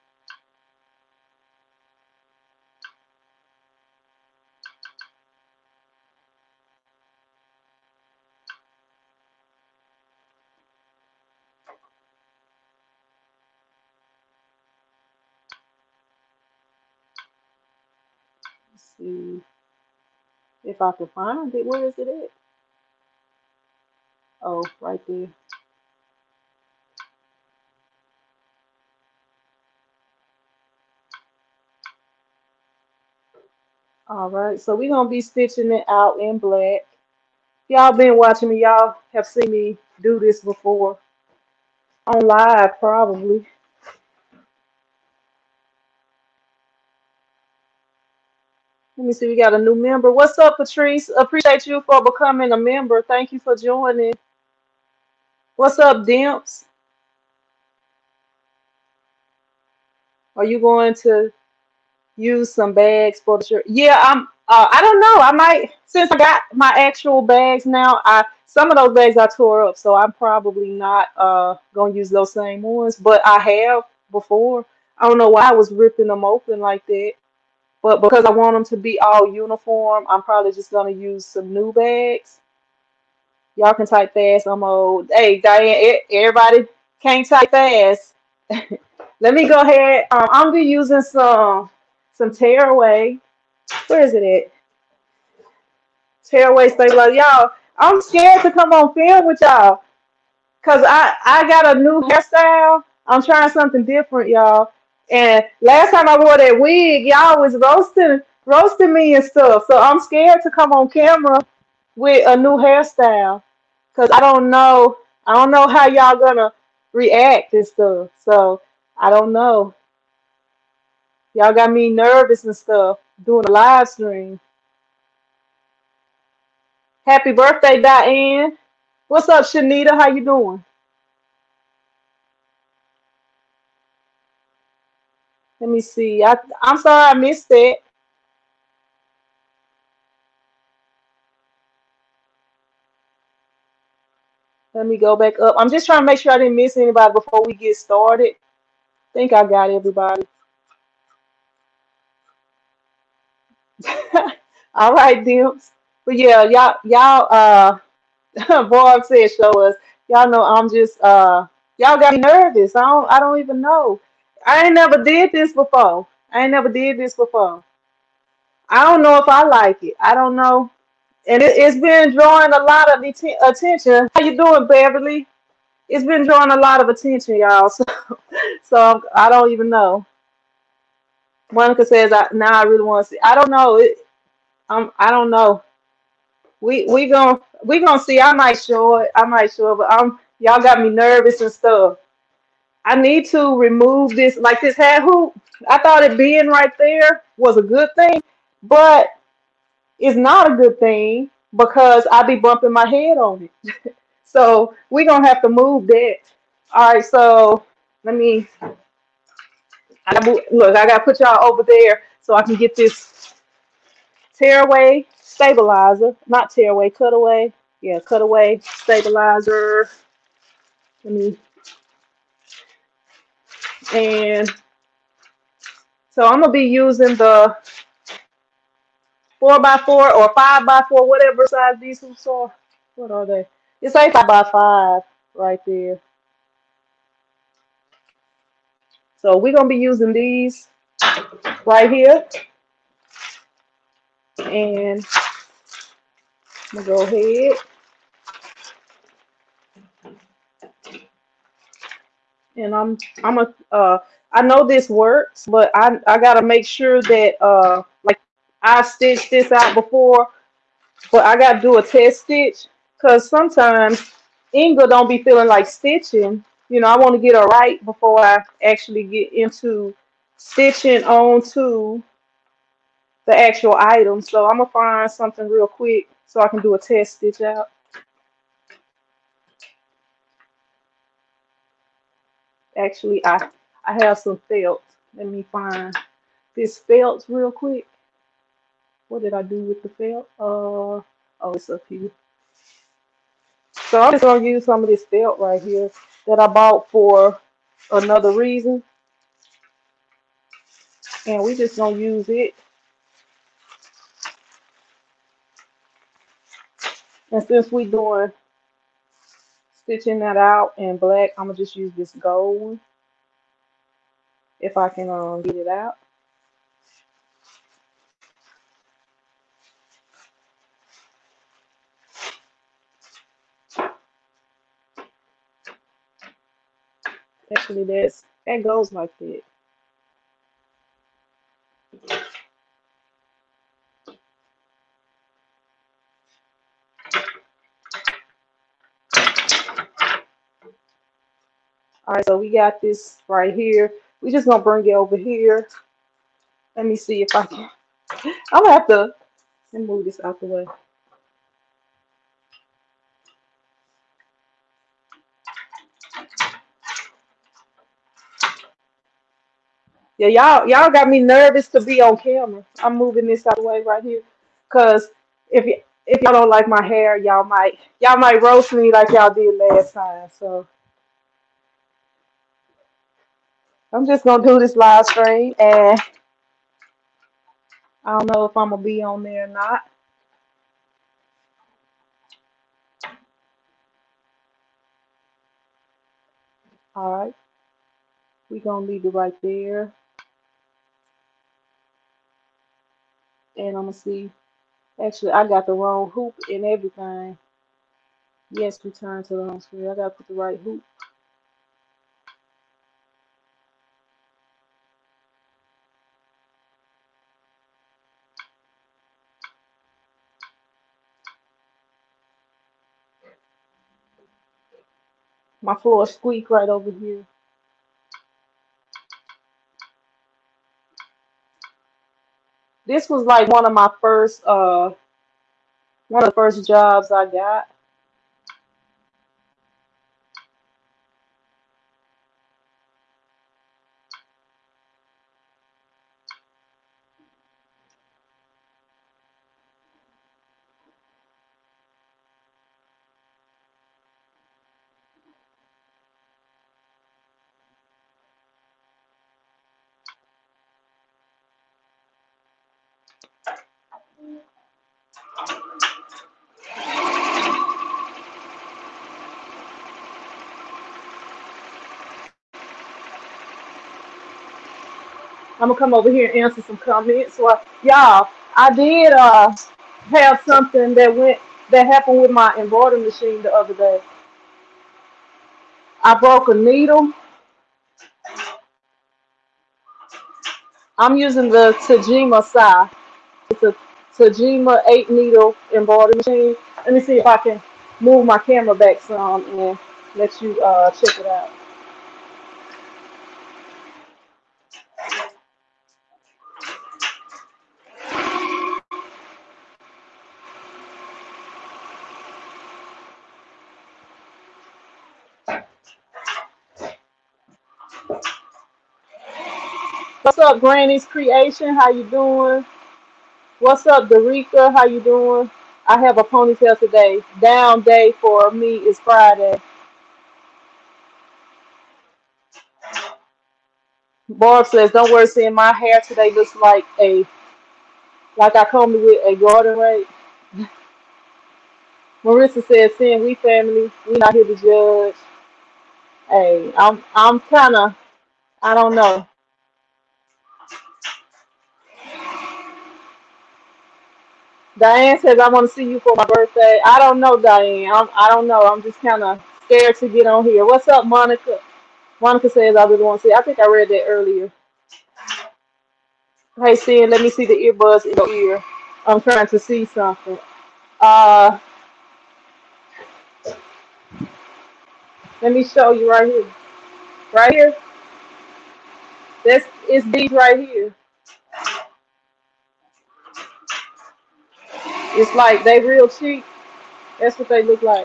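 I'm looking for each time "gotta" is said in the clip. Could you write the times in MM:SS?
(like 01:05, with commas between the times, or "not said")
04:16, 04:21, 06:39.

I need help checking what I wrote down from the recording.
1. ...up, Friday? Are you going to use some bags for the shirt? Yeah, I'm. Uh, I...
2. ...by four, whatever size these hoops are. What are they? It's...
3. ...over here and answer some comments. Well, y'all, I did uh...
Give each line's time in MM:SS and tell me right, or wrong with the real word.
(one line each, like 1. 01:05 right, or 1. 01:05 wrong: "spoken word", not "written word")
1. 00:55 wrong: "Dimps", not "Friday"
2. 03:50 right
3. 07:45 right.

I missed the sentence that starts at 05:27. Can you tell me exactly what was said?
Actually, that's that goes like that.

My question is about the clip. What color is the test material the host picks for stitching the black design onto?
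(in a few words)
Gold.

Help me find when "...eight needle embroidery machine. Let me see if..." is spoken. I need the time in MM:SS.
08:04.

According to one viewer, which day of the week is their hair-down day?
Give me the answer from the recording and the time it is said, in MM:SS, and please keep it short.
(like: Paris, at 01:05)
Friday, at 08:38.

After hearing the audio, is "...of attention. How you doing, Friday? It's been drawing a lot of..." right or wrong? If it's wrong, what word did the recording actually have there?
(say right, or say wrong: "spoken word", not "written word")
wrong: "Beverly", not "Friday".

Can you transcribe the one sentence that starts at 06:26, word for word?
All right, we're gonna leave it right there.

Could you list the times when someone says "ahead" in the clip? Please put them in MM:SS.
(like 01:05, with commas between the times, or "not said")
01:29, 04:07.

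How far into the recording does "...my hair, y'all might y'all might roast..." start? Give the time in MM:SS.
06:06.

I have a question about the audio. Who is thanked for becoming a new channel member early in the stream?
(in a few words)
Patrice.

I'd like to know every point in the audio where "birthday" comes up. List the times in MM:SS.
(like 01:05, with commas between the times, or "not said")
02:07, 09:06.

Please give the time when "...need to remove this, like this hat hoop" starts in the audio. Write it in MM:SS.
03:12.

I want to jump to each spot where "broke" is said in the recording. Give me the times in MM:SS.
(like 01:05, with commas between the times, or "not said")
07:56.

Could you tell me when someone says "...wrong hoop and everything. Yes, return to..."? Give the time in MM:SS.
06:35.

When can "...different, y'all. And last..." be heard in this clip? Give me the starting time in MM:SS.
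01:43.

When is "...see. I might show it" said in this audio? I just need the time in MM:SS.
03:08.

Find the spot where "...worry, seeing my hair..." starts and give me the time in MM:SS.
08:45.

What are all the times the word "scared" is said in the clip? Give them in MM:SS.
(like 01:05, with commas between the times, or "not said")
01:38, 01:49, 09:09.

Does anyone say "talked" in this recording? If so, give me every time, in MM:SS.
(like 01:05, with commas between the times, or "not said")
not said.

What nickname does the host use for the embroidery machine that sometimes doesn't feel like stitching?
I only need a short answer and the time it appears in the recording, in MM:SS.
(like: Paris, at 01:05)
Inga, at 04:24.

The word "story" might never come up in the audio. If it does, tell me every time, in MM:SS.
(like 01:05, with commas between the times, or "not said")
not said.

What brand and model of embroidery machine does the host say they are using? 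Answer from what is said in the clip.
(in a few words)
Tajima Sai.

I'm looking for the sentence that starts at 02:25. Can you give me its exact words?
I'm just trying to make sure I didn't miss anybody before we get started.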